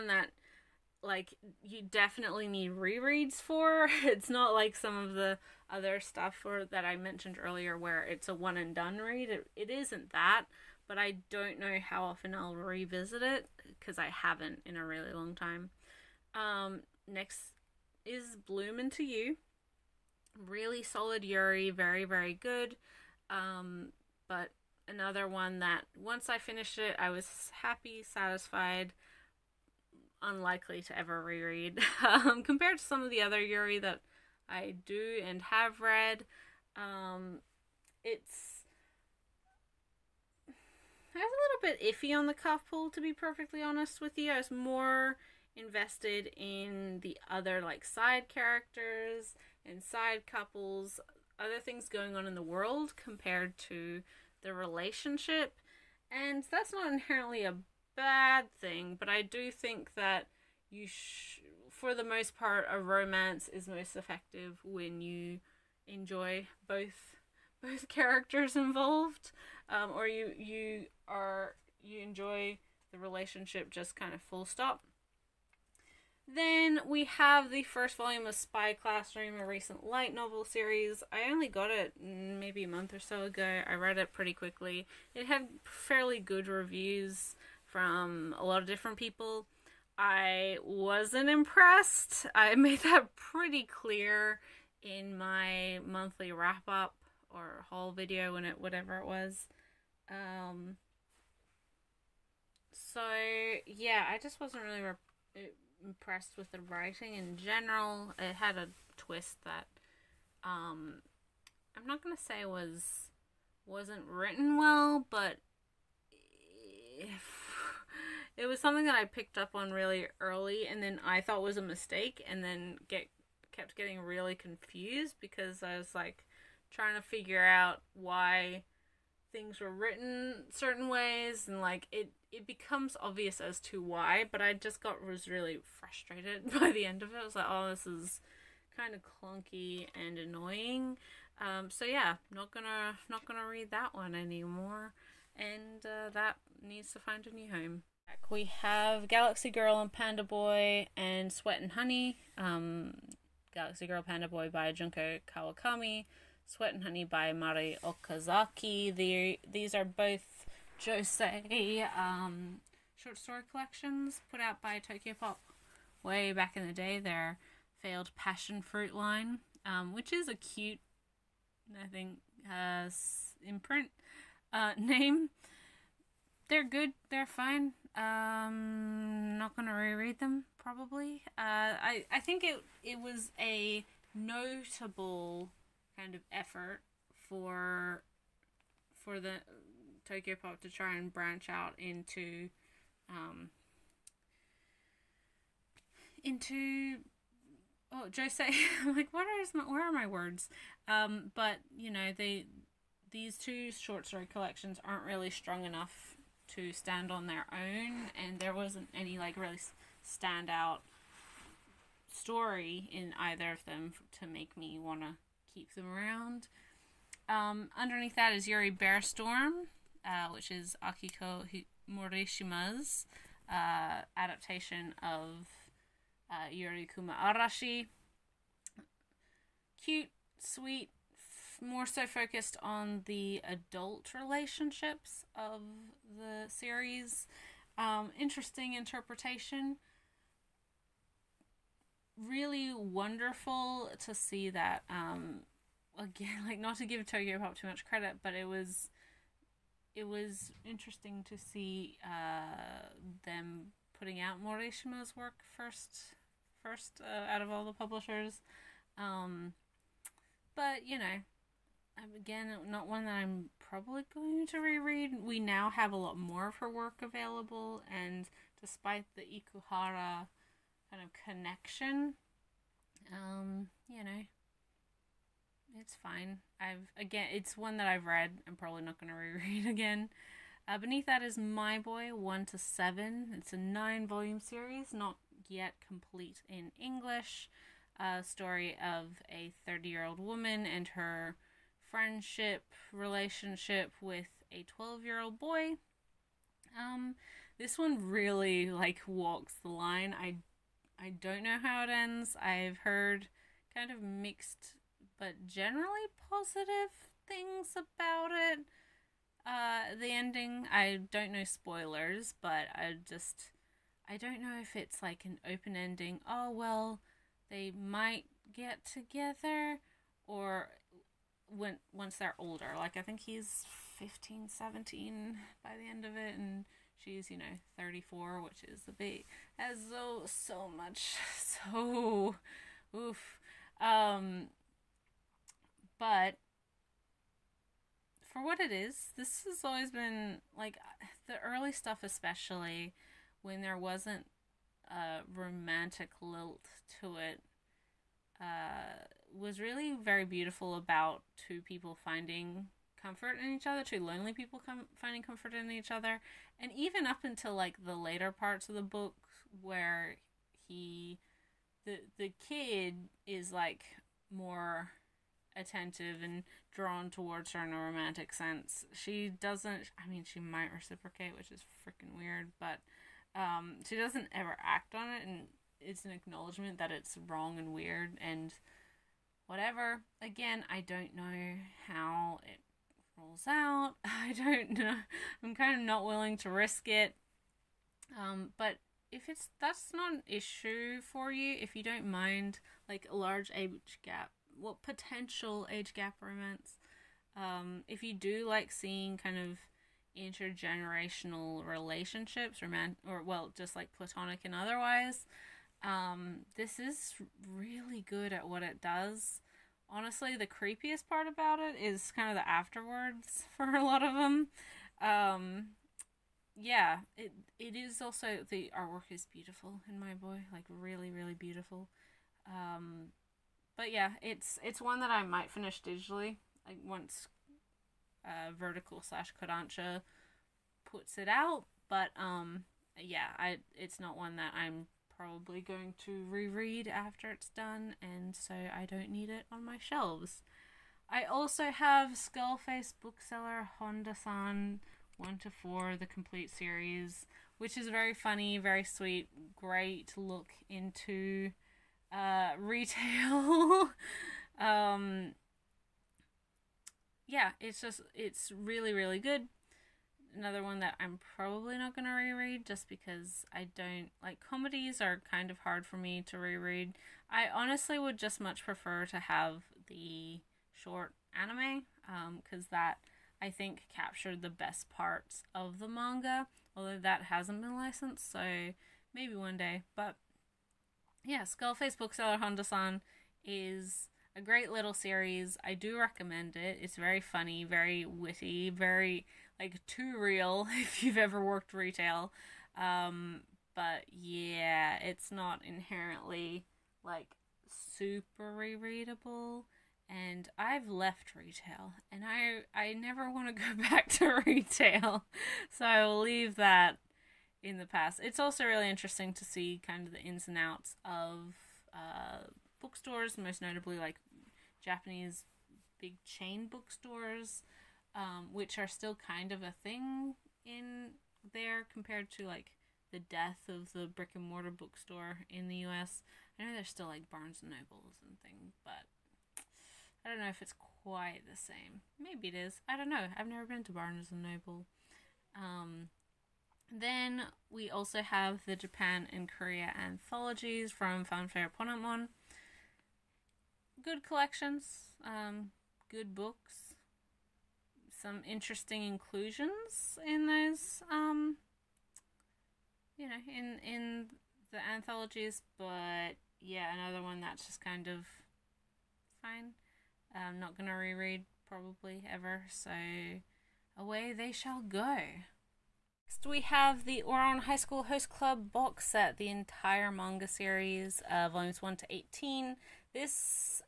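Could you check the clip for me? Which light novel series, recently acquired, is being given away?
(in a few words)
Spy Classroom.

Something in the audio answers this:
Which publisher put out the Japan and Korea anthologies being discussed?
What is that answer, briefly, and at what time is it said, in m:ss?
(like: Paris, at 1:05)
Fanfare Ponent Mon, at 9:01.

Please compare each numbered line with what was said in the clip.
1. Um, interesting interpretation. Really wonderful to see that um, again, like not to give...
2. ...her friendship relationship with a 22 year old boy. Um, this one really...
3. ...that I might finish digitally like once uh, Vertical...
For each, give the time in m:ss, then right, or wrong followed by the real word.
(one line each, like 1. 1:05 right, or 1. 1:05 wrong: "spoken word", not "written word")
1. 3:57 right
2. 4:50 wrong: "12", not "22"
3. 7:05 right.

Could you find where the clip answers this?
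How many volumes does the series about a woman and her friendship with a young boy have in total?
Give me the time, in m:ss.
4:43.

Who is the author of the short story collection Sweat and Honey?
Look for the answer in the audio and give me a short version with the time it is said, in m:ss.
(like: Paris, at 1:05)
Mari Okazaki, at 2:37.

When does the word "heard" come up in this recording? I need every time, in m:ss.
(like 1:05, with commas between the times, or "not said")
5:02.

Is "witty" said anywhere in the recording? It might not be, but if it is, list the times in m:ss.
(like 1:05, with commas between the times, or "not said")
8:08.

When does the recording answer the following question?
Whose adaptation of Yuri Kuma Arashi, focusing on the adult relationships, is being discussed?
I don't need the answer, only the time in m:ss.
3:40.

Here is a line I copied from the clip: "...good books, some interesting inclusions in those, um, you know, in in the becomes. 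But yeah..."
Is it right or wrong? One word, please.
wrong.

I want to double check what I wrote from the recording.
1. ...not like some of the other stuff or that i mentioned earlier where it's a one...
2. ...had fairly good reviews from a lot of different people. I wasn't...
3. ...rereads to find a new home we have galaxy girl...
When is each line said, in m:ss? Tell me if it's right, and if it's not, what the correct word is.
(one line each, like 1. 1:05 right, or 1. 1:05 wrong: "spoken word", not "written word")
1. 0:04 right
2. 1:25 right
3. 2:26 wrong: "needs", not "rereads".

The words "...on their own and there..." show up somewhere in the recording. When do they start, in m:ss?
3:27.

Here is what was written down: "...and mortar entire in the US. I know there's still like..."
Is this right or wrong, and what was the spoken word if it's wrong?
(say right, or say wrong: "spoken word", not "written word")
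wrong: "bookstore", not "entire".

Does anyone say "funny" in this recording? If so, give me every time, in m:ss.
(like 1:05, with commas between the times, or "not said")
7:28, 8:07.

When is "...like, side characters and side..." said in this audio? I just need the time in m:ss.
0:47.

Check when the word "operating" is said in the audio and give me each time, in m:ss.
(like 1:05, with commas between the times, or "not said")
not said.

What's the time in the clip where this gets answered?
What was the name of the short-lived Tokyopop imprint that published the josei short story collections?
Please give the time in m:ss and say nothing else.
2:48.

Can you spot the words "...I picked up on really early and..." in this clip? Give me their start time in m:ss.
1:58.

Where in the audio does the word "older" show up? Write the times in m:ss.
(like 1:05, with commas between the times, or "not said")
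5:22.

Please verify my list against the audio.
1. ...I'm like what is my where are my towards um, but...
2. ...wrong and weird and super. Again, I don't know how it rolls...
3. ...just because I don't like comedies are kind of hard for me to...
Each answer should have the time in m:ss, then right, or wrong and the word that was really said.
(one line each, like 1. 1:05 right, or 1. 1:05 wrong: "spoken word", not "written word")
1. 3:18 wrong: "words", not "towards"
2. 6:17 wrong: "whatever", not "super"
3. 7:42 right.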